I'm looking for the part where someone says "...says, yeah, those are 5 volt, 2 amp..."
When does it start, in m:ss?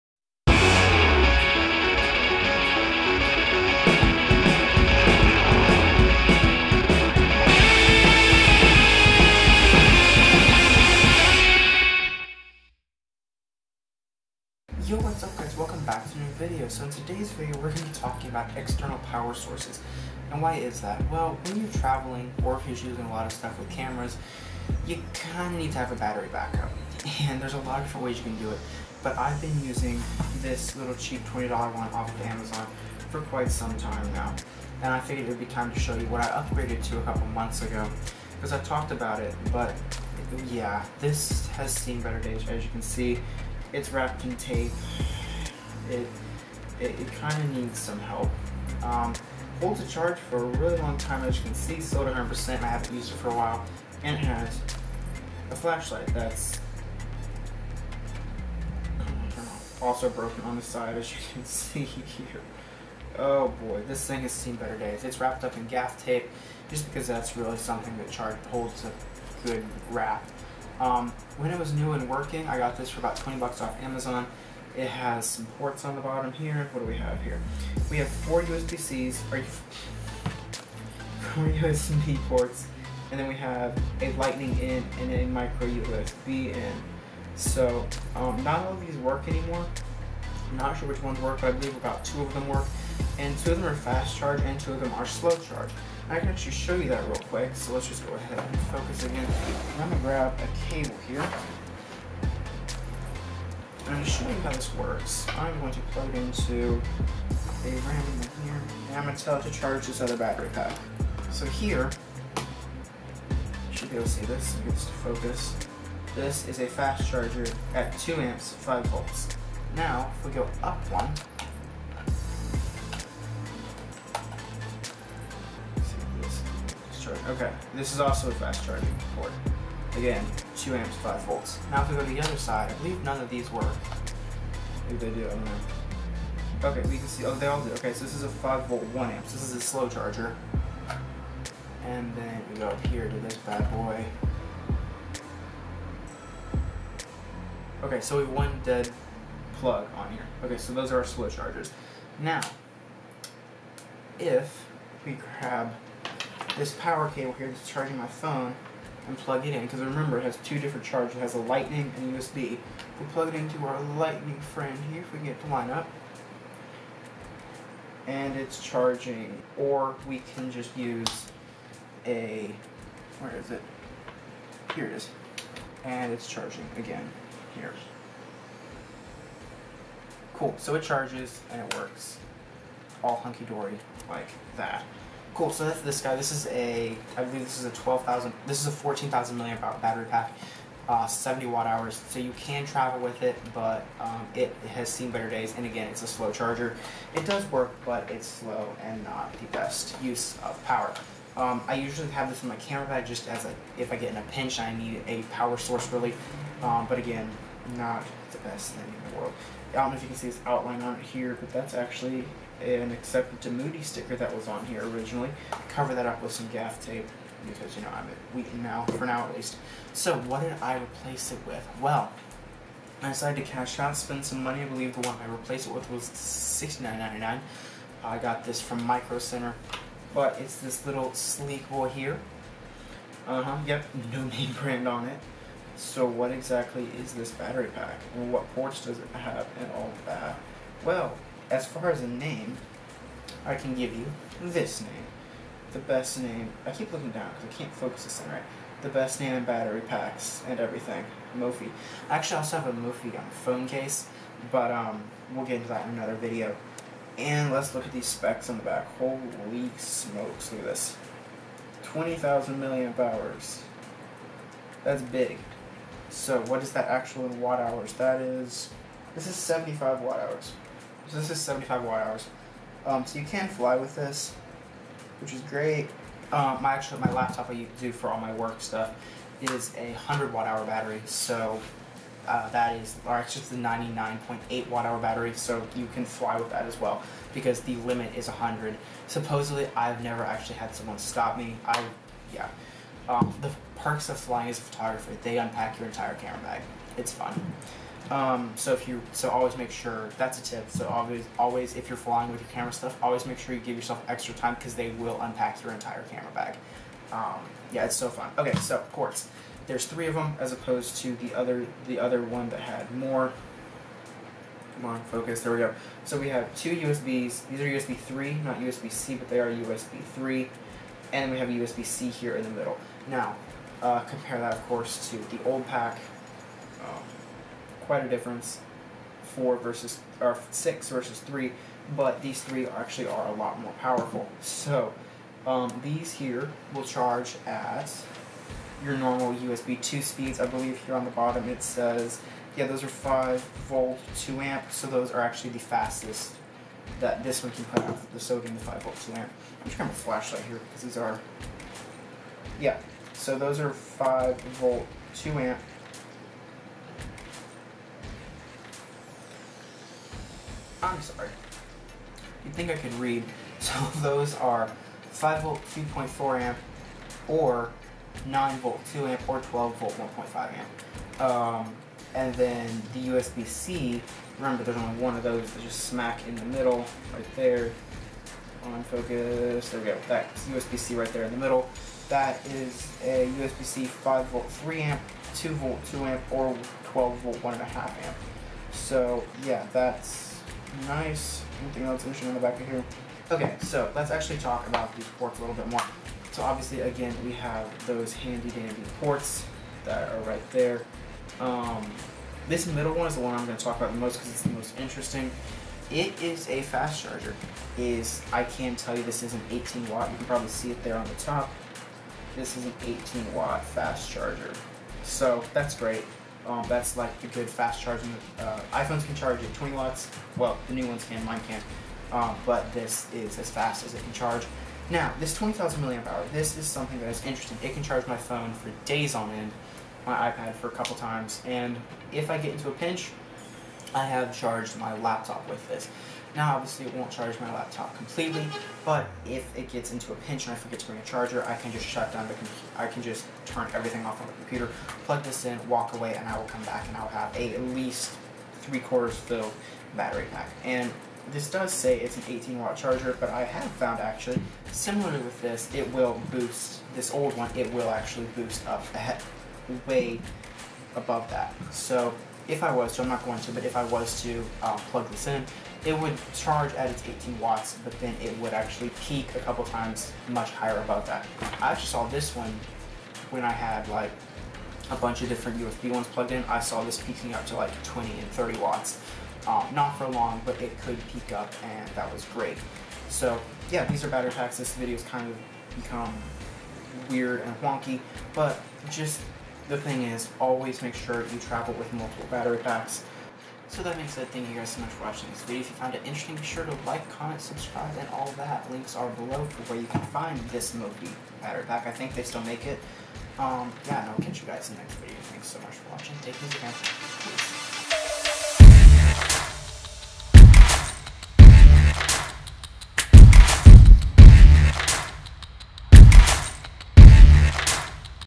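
5:41.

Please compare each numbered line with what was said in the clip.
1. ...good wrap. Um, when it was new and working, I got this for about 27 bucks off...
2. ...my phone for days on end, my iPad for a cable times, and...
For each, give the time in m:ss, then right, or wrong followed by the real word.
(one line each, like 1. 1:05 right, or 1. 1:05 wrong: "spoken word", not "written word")
1. 1:09 wrong: "20", not "27"
2. 7:08 wrong: "couple", not "cable".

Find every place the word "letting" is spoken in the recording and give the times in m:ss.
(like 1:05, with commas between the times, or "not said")
not said.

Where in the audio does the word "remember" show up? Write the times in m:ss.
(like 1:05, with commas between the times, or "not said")
2:39, 6:14.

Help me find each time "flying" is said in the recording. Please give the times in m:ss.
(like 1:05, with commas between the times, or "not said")
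4:54, 5:01.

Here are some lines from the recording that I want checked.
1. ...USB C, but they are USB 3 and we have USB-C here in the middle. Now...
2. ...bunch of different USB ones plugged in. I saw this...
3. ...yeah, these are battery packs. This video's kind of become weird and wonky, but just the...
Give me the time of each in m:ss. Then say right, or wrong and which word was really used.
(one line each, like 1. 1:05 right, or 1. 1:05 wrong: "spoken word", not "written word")
1. 5:18 right
2. 7:54 right
3. 8:03 right.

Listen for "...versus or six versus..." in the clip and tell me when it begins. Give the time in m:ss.
5:29.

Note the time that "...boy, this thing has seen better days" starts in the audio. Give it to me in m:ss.
1:03.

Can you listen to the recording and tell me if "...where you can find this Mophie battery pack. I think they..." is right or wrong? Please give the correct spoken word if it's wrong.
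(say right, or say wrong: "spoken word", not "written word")
right.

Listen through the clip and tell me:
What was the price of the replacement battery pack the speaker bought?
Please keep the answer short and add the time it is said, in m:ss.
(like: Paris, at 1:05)
$69.99, at 3:46.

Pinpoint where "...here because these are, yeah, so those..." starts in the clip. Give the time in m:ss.
5:50.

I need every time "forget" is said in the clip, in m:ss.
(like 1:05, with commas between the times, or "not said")
7:20.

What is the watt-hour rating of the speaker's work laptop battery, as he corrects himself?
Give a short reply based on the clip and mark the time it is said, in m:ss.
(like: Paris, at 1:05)
99.8 watt hours, at 4:43.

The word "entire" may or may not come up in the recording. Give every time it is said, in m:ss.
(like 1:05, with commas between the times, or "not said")
4:55, 5:05.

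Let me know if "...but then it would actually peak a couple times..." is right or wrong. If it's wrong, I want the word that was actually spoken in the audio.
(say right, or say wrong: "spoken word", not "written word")
right.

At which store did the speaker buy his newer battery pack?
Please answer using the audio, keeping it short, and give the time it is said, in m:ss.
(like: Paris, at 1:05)
Micro Center, at 3:48.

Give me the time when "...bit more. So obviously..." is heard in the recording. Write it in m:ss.
6:35.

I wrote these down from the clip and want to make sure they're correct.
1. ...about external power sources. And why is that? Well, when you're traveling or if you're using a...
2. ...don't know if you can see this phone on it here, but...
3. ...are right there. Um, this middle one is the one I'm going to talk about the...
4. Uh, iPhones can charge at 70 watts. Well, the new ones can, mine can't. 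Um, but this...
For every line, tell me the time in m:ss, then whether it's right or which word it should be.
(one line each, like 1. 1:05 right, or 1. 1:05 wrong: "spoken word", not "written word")
1. 0:18 right
2. 3:29 wrong: "outline", not "phone"
3. 6:40 right
4. 6:58 wrong: "20", not "70".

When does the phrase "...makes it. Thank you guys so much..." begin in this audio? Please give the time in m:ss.
8:13.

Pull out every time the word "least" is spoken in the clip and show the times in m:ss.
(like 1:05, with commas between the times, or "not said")
3:39, 7:27.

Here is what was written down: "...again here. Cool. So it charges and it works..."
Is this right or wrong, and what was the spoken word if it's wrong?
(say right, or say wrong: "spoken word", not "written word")
right.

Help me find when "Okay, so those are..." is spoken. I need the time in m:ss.
2:30.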